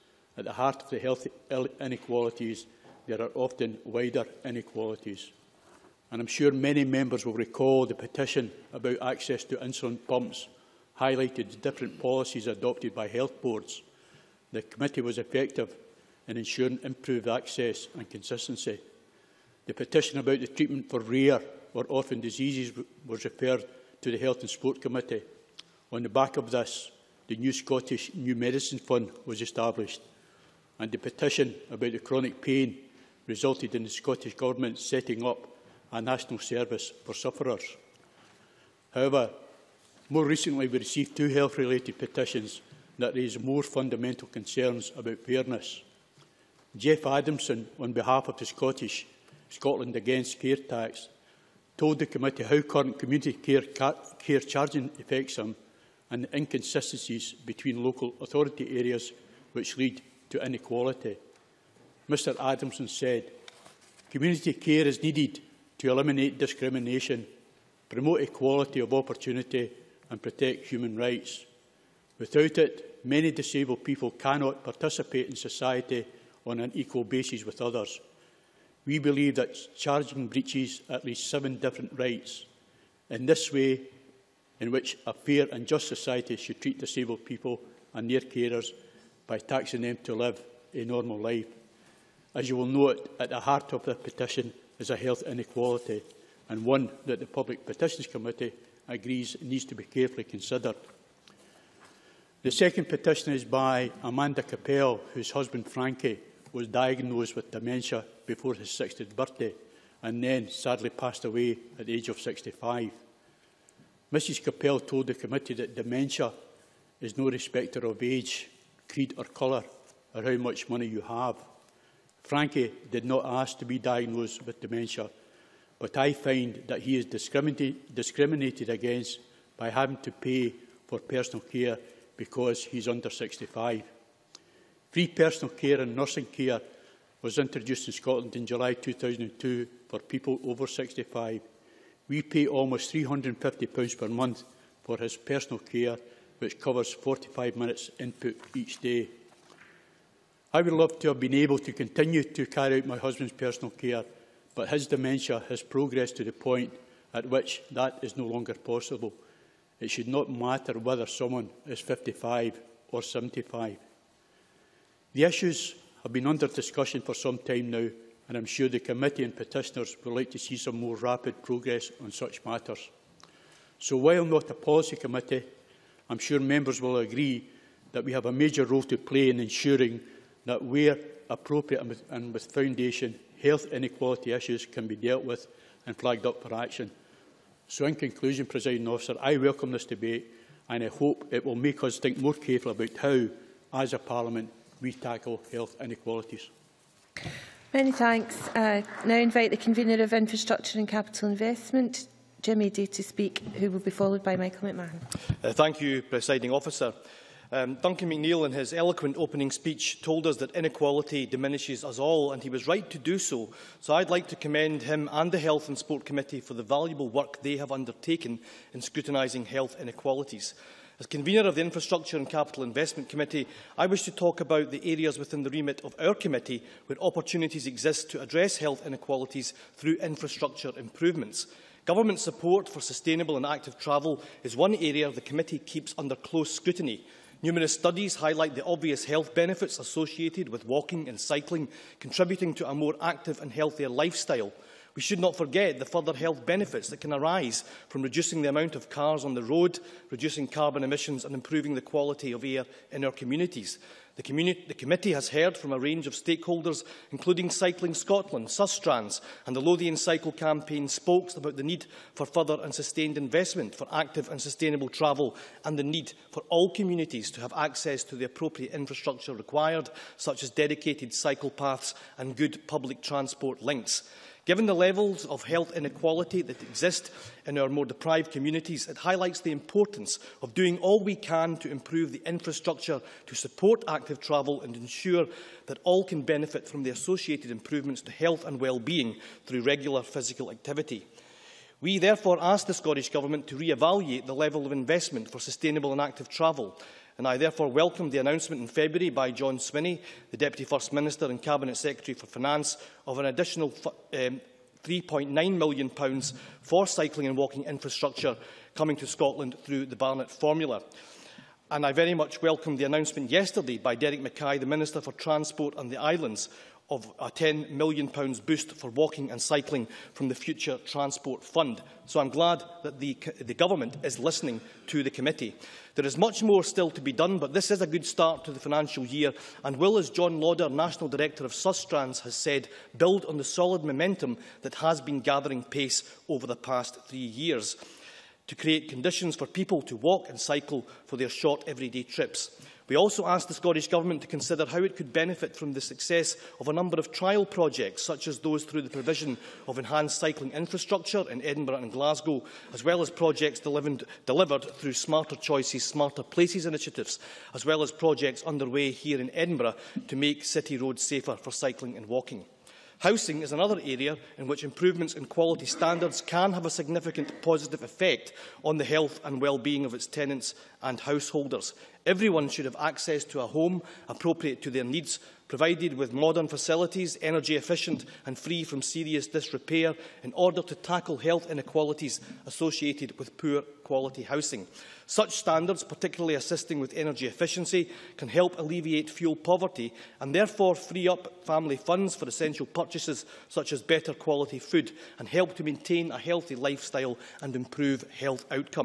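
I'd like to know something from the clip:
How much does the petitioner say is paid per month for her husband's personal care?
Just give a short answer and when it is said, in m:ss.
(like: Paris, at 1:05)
£350, at 2:22.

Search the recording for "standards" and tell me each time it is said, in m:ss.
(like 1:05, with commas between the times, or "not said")
6:05, 6:25.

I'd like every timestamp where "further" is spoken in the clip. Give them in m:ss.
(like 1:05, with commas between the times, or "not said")
4:05, 4:22.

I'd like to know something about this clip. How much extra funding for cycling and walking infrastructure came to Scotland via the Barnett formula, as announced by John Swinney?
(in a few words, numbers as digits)
£3.9 million.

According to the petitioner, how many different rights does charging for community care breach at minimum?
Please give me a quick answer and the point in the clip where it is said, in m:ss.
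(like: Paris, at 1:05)
7, at 1:21.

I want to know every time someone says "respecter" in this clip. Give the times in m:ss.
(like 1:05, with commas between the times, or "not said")
1:57.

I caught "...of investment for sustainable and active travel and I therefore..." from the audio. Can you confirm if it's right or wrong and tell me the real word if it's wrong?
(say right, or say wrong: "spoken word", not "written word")
right.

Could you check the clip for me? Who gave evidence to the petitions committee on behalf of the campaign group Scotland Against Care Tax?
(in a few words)
Jeff Adamson.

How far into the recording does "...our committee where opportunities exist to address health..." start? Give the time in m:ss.
3:45.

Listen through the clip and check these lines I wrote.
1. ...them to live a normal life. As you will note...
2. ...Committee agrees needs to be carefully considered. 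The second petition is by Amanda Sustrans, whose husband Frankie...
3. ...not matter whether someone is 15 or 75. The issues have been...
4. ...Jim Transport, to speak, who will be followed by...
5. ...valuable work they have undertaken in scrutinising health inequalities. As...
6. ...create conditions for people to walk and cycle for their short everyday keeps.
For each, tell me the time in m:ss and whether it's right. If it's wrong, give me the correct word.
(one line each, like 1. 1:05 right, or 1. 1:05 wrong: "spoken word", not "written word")
1. 1:29 right
2. 1:38 wrong: "Kopel", not "Sustrans"
3. 2:40 wrong: "55", not "15"
4. 3:22 wrong: "Eadie", not "Transport"
5. 3:36 right
6. 5:38 wrong: "trips", not "keeps".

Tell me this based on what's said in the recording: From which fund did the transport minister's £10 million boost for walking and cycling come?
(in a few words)
Future Transport Fund.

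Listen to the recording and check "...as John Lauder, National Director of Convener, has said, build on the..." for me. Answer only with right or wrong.
wrong.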